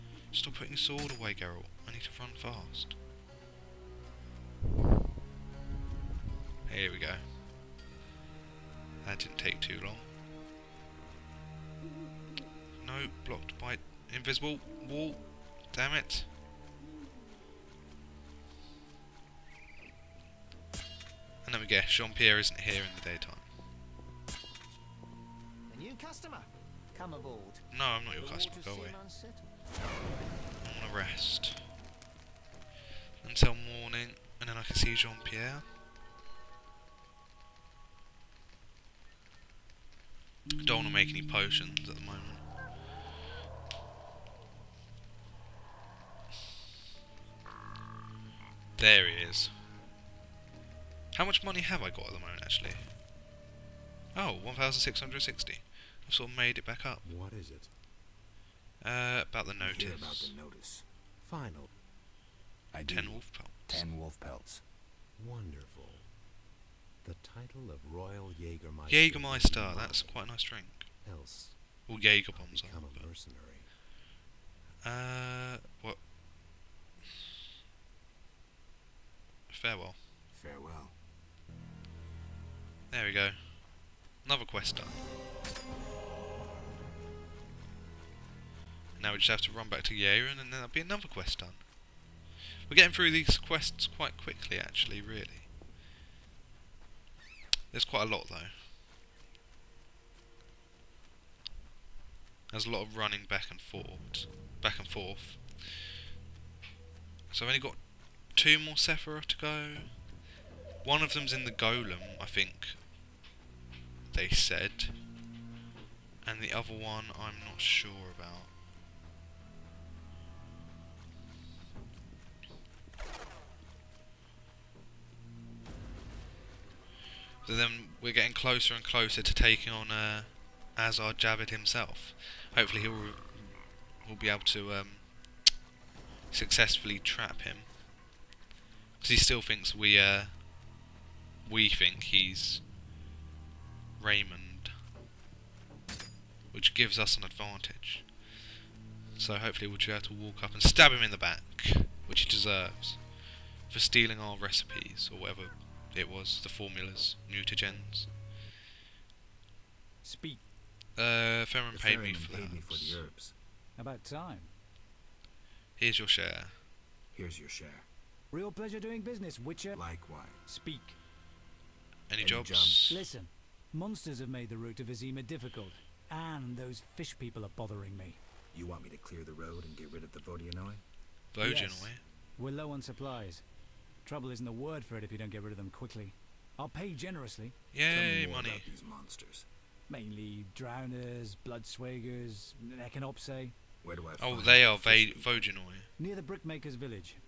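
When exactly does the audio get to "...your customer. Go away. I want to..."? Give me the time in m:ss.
0:28.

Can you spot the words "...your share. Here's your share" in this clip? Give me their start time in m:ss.
2:45.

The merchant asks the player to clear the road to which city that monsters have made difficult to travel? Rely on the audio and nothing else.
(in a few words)
Vizima.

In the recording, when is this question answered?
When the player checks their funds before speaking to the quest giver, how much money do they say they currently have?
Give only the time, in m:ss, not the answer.
0:54.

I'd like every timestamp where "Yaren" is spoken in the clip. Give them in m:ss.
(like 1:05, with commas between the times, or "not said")
1:29.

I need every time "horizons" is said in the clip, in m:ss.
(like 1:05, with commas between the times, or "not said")
not said.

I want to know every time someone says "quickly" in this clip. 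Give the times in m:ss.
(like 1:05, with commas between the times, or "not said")
1:34, 3:05.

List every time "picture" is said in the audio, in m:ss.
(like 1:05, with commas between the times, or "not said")
not said.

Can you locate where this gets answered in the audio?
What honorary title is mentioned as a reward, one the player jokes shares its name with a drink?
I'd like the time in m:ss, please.
1:07.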